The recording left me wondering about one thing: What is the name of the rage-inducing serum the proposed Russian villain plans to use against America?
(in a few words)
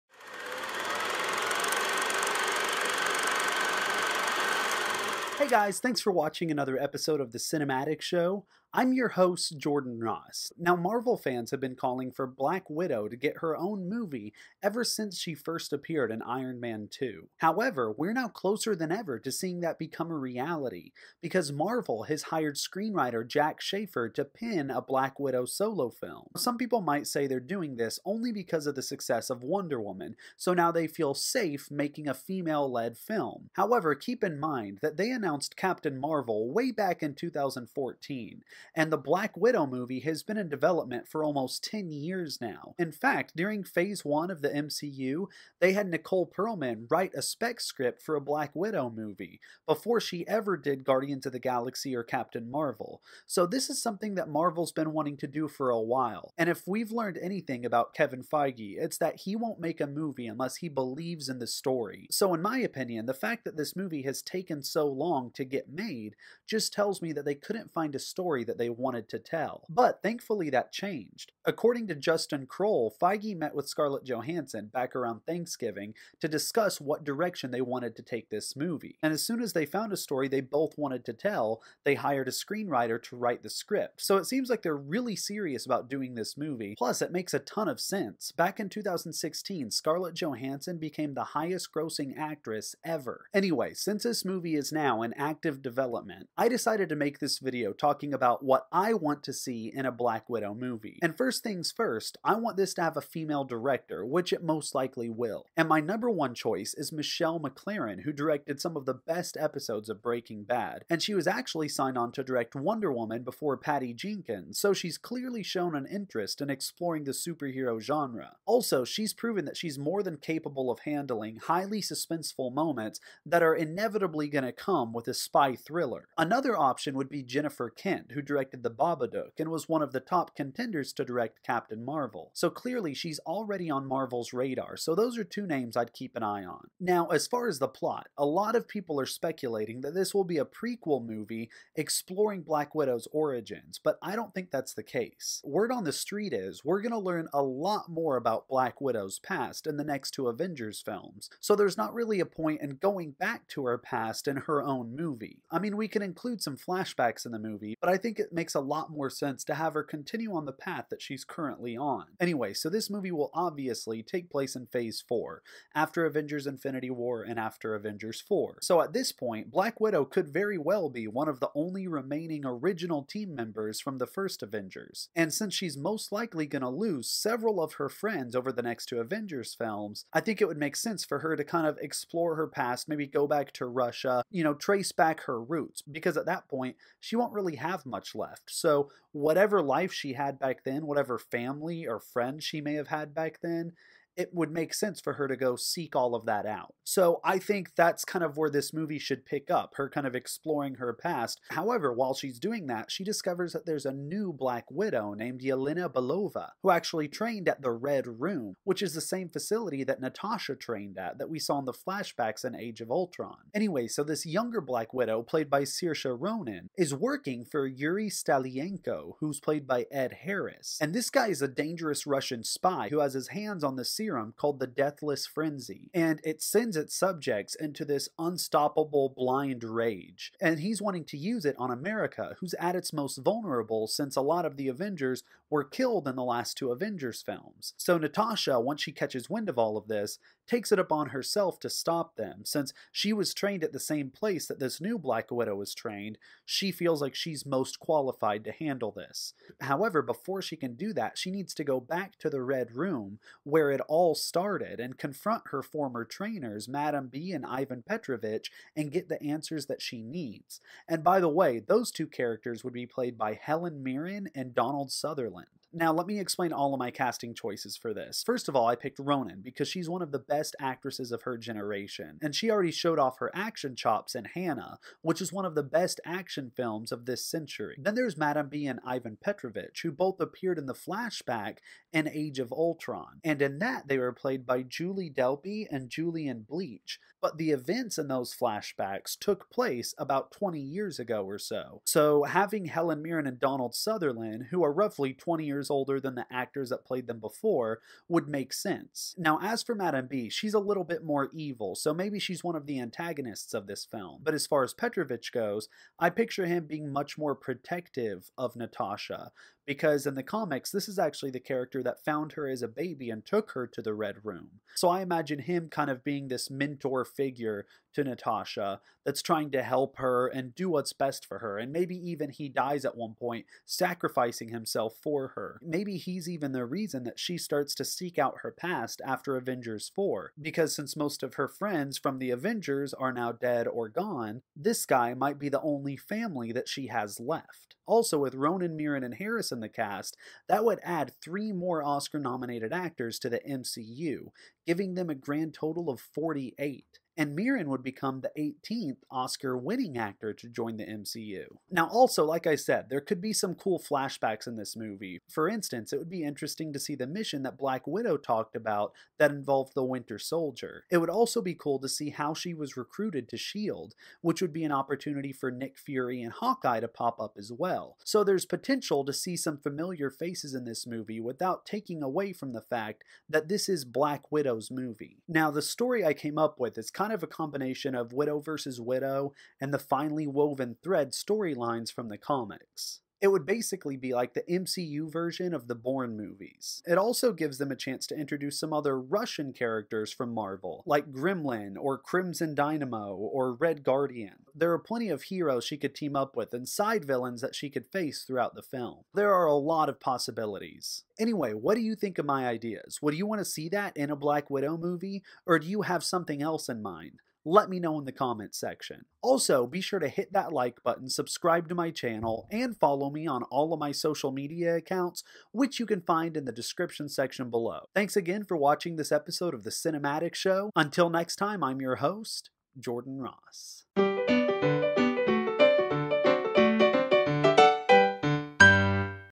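Deathless Frenzy.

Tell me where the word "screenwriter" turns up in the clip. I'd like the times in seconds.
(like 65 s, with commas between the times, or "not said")
22 s, 82 s.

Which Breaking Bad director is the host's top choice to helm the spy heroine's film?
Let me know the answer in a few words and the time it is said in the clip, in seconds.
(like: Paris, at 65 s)
Michelle MacLaren, at 106 s.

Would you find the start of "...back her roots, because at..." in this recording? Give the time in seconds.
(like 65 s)
184 s.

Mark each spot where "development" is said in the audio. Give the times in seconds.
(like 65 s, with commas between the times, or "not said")
40 s, 95 s.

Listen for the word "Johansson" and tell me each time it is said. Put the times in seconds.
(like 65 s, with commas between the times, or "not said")
74 s, 90 s.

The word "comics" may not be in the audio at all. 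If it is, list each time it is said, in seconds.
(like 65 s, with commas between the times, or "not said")
310 s, 382 s.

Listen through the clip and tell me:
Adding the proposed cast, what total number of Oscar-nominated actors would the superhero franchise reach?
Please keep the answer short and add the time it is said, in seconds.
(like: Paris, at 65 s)
48, at 345 s.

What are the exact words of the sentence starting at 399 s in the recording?
There are a lot of possibilities.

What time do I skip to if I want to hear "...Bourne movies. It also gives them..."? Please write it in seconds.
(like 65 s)
385 s.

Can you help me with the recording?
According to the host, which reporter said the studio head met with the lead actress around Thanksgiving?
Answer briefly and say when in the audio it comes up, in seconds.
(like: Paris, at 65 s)
Justin Kroll, at 71 s.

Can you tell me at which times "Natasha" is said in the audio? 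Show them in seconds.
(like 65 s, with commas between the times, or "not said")
210 s, 237 s, 308 s, 318 s.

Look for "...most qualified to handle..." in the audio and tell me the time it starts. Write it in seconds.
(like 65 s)
247 s.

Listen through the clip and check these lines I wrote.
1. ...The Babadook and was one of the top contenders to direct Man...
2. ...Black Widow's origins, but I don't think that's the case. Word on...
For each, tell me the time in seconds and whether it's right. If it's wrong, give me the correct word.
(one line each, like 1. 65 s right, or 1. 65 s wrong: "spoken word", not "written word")
1. 128 s wrong: "Captain", not "Man"
2. 142 s right.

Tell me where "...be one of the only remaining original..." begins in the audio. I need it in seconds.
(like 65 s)
170 s.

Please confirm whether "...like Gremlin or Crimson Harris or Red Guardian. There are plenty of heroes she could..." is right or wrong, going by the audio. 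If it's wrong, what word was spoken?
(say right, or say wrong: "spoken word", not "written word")
wrong: "Dynamo", not "Harris".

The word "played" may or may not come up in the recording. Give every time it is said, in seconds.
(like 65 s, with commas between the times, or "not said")
215 s, 219 s, 262 s, 284 s, 296 s.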